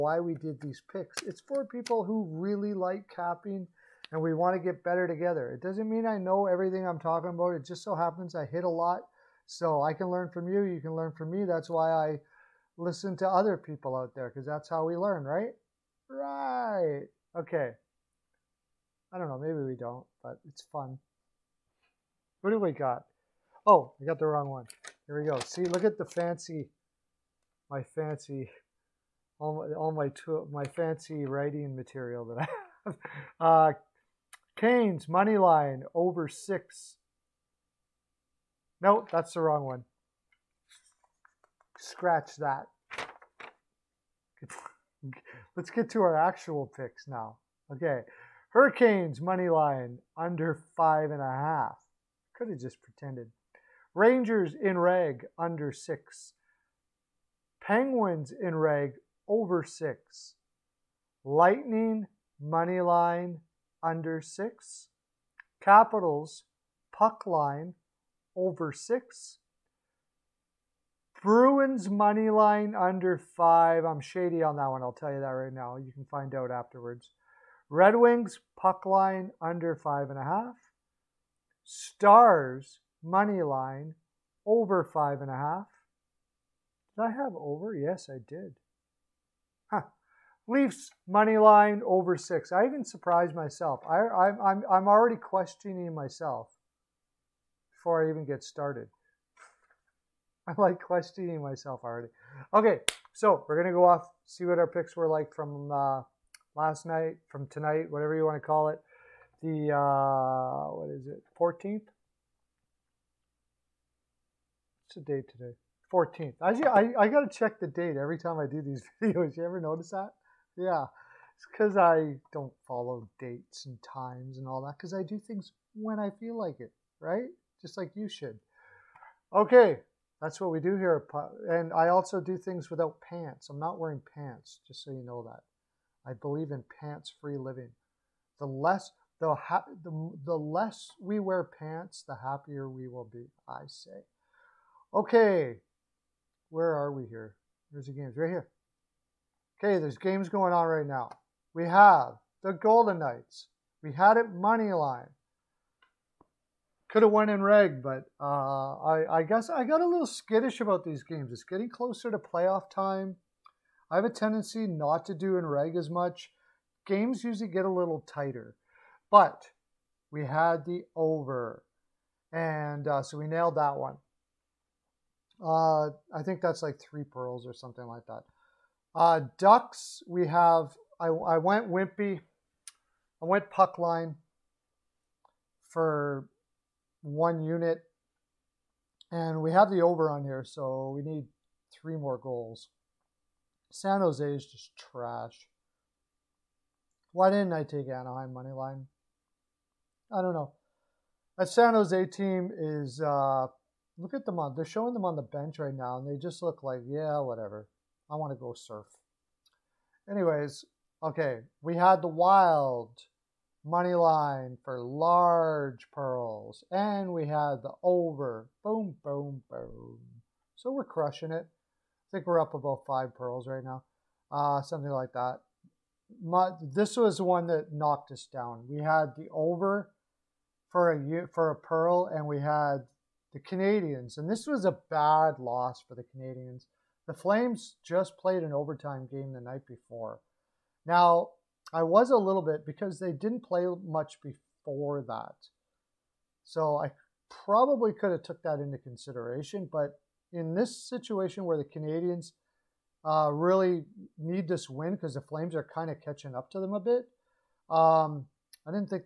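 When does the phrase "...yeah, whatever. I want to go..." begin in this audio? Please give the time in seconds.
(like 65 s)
206 s.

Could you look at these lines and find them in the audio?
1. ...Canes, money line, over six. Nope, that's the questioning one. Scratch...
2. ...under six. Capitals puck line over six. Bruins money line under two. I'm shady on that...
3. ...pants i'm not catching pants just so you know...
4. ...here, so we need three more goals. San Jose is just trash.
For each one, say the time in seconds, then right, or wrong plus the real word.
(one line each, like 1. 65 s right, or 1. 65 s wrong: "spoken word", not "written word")
1. 34 s wrong: "wrong", not "questioning"
2. 63 s wrong: "five", not "two"
3. 133 s wrong: "wearing", not "catching"
4. 190 s right.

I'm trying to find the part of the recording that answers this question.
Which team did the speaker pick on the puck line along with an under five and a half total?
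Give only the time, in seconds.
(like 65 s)
77 s.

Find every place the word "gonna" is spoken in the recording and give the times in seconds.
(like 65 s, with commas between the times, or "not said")
103 s.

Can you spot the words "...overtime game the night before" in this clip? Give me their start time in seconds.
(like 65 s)
238 s.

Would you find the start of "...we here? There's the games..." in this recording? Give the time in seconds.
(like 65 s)
146 s.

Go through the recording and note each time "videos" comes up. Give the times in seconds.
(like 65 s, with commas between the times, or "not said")
119 s.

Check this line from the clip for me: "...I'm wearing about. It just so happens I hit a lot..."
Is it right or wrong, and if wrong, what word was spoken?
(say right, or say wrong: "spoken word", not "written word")
wrong: "talking", not "wearing".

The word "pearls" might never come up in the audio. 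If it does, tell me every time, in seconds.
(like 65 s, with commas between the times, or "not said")
177 s, 215 s, 223 s, 231 s.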